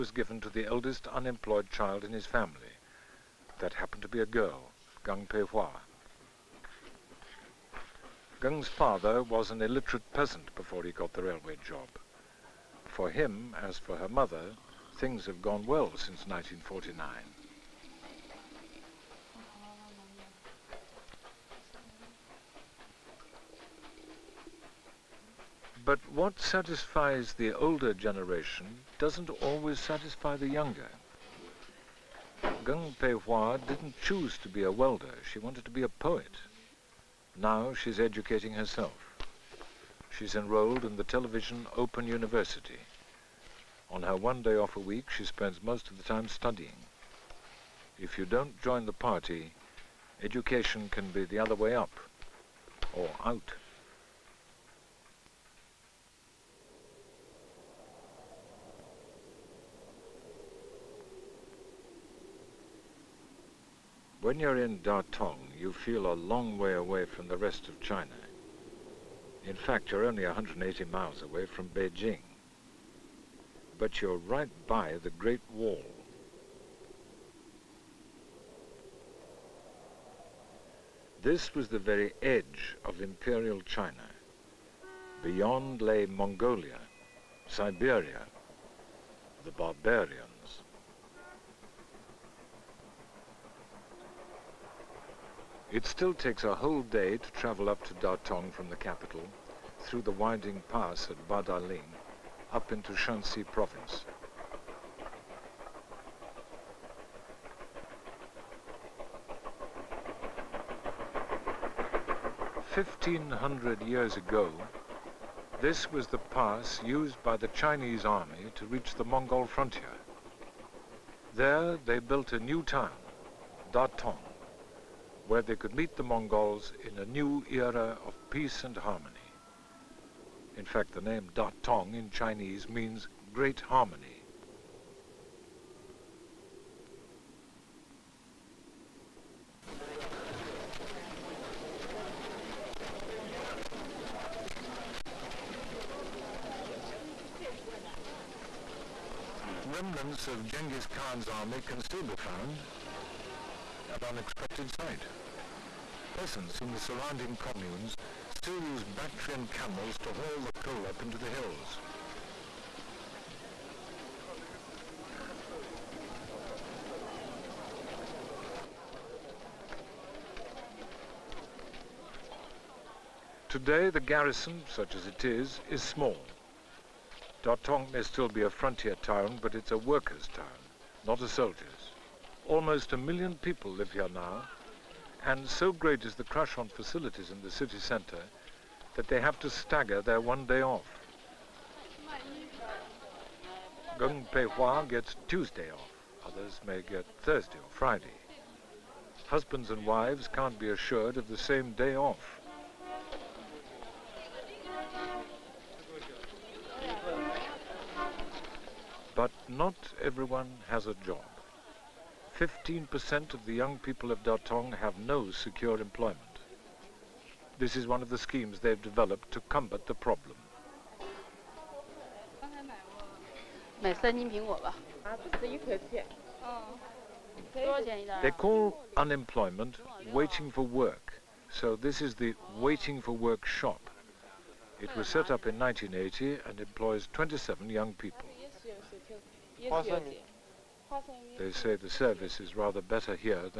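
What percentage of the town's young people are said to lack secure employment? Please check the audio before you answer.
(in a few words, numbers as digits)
15%.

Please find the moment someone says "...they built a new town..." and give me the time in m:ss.
2:01.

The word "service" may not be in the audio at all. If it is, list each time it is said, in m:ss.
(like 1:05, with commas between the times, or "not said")
4:01.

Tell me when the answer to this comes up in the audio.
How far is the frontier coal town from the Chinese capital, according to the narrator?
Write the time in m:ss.
1:10.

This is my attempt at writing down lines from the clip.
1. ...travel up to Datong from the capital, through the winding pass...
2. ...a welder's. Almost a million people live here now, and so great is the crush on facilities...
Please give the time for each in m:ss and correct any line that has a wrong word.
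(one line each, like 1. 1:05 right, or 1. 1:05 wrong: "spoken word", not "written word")
1. 1:37 right
2. 3:01 wrong: "soldier", not "welder".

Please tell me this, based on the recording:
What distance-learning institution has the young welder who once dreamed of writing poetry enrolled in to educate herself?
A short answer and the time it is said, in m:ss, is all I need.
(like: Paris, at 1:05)
Television Open University, at 0:41.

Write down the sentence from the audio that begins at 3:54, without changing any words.
It was set up in 1980 and employs 27 young people.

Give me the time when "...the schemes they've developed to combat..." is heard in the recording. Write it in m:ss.
3:38.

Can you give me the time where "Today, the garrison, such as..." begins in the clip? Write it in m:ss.
2:53.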